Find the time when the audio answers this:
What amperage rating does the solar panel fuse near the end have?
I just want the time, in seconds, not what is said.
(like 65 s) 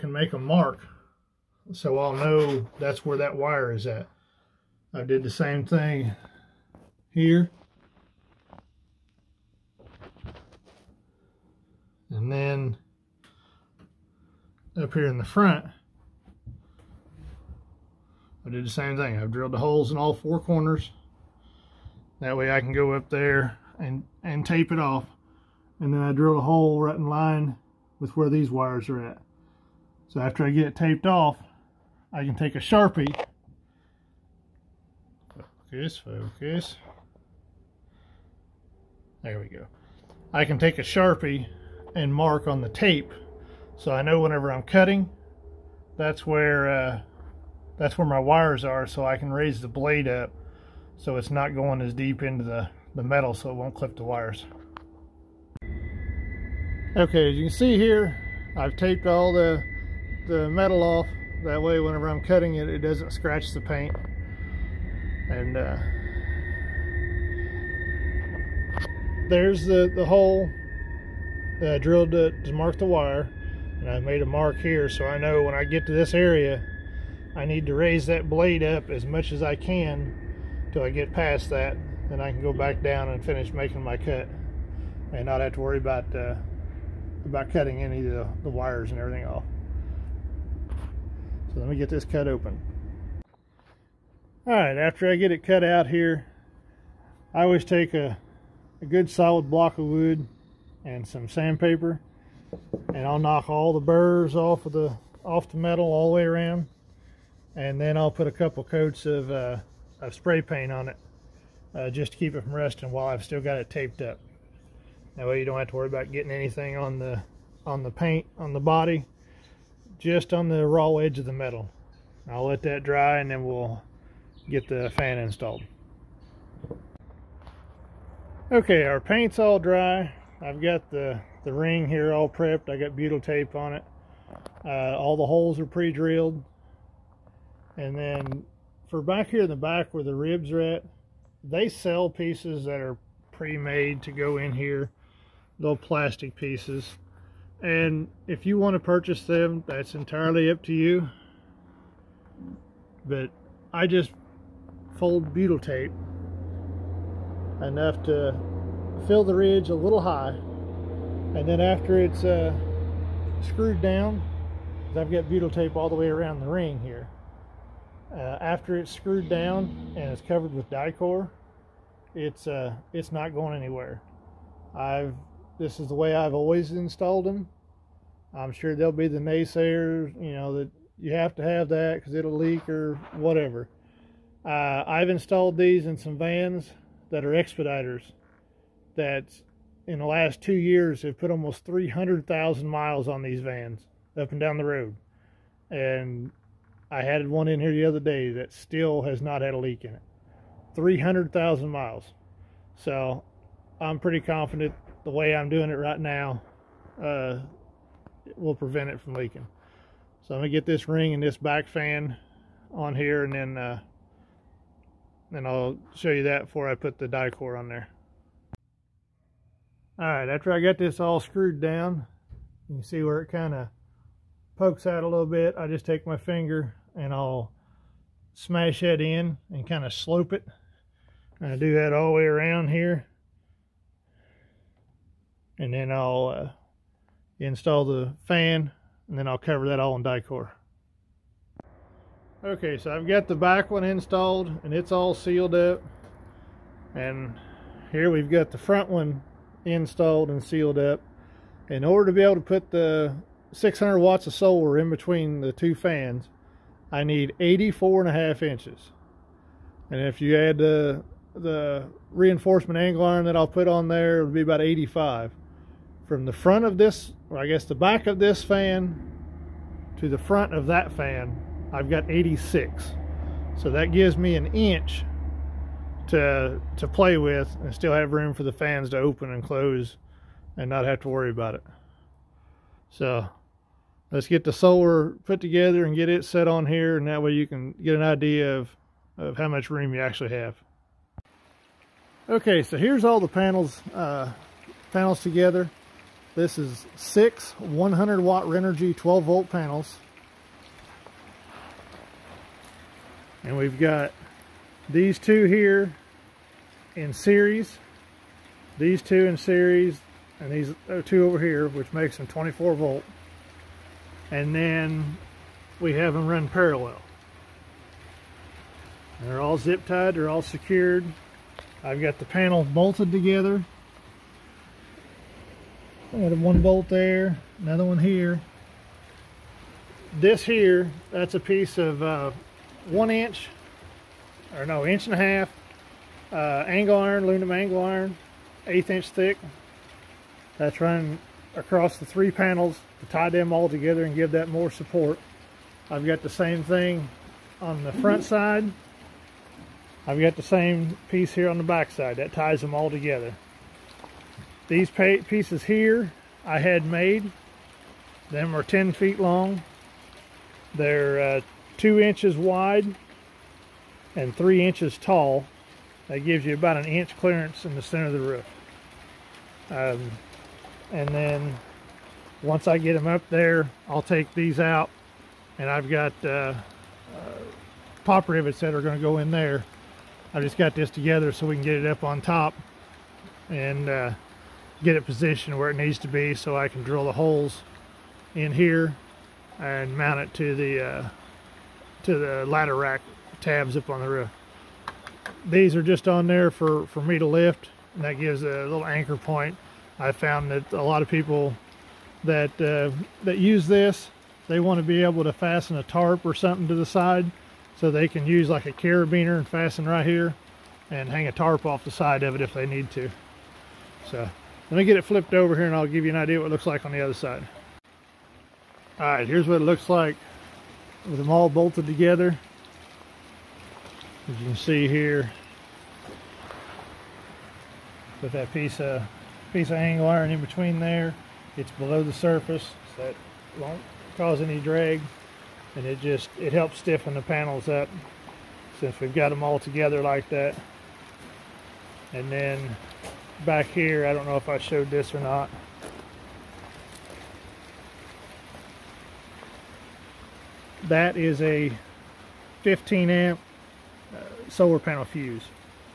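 452 s.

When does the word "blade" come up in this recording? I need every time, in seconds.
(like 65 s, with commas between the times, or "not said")
49 s, 78 s.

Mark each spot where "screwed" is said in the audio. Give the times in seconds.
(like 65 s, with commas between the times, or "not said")
163 s, 168 s, 221 s.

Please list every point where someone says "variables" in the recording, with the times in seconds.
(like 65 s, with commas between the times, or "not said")
not said.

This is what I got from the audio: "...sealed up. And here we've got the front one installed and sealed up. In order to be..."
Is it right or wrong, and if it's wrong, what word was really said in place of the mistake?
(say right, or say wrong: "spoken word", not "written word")
right.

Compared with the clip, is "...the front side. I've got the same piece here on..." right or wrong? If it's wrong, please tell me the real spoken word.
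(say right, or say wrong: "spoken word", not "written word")
right.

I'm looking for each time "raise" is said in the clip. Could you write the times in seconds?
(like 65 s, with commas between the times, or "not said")
49 s, 77 s.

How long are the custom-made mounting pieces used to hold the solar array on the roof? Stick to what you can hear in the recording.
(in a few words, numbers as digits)
10 feet.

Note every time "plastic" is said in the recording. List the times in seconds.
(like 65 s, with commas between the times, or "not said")
145 s.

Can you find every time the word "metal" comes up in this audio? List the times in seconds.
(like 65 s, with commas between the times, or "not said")
53 s, 60 s, 105 s, 121 s.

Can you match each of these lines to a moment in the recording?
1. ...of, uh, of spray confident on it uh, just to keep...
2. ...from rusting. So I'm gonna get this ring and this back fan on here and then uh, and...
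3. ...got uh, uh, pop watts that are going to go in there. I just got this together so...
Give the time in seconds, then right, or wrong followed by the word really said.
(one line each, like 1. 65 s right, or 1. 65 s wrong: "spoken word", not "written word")
1. 109 s wrong: "paint", not "confident"
2. 209 s wrong: "leaking", not "rusting"
3. 375 s wrong: "rivets", not "watts".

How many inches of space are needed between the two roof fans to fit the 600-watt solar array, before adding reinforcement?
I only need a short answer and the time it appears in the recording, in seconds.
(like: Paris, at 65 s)
84 and a half inches, at 257 s.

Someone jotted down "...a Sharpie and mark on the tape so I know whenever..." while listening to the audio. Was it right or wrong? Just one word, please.
right.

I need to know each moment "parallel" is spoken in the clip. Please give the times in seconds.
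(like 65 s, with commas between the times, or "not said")
316 s.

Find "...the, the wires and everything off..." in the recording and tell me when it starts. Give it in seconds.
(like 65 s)
88 s.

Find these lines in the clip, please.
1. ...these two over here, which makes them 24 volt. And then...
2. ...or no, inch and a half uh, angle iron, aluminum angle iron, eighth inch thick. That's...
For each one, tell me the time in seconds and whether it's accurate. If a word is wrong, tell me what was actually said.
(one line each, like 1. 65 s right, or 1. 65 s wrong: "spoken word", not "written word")
1. 310 s right
2. 334 s right.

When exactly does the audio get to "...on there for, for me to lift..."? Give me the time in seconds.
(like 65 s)
396 s.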